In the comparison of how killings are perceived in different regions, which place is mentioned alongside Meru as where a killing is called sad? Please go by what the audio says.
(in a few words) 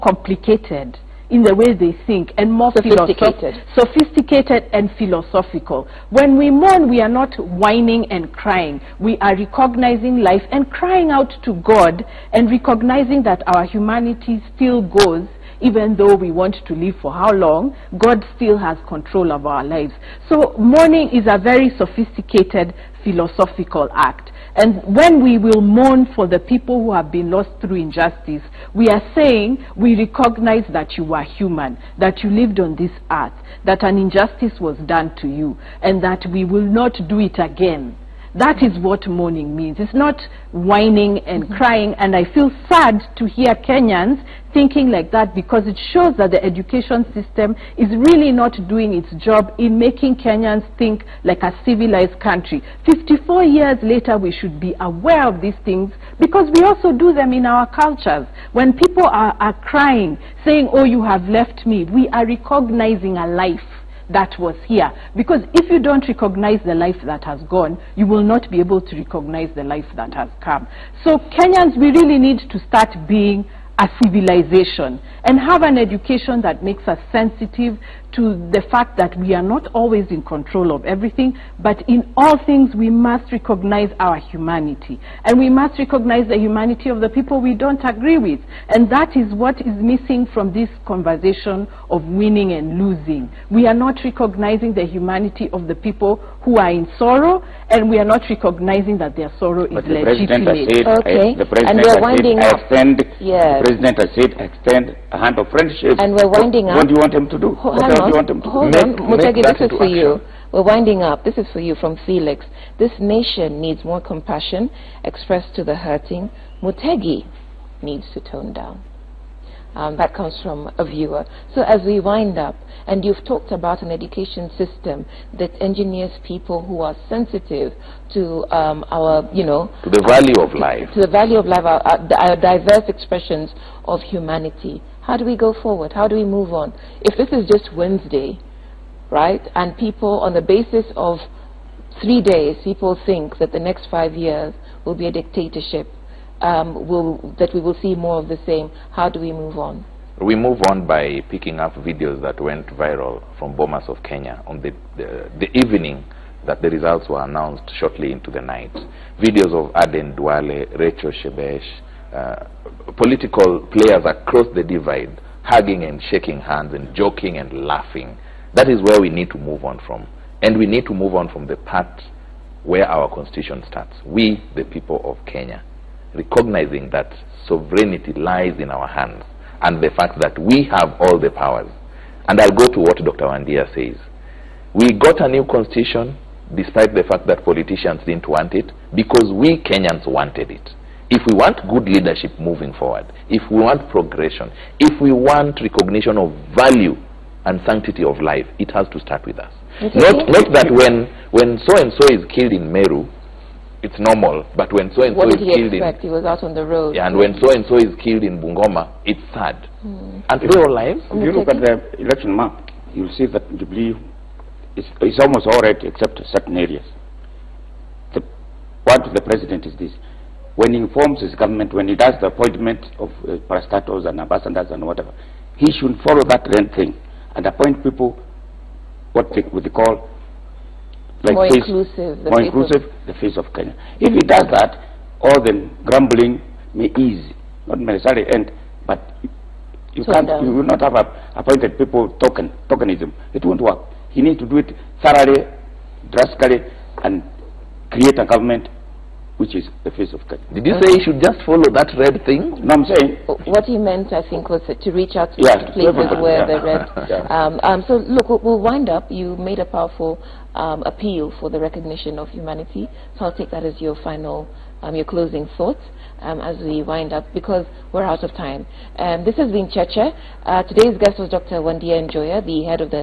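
Bungoma.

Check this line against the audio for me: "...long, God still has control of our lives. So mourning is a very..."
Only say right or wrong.
right.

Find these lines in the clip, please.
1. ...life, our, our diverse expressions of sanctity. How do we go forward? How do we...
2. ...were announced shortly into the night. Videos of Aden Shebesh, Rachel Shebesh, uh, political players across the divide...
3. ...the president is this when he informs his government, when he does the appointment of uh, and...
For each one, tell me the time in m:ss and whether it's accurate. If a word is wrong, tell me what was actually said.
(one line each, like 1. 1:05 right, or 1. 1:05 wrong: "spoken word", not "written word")
1. 2:11 wrong: "humanity", not "sanctity"
2. 2:37 wrong: "Duale", not "Shebesh"
3. 3:39 right.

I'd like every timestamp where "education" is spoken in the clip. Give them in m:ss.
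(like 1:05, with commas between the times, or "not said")
0:46, 1:15, 2:03.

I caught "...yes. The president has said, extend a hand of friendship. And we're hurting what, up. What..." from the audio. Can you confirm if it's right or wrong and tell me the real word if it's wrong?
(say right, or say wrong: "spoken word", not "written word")
wrong: "winding", not "hurting".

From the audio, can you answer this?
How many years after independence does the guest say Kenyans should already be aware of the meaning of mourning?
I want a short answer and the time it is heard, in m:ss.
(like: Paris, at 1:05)
54, at 0:52.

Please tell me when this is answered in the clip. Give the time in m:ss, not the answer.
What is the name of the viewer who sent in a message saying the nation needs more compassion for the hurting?
1:52.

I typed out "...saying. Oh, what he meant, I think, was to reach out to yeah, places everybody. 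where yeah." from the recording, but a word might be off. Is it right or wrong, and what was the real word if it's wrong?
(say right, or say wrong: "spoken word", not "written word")
right.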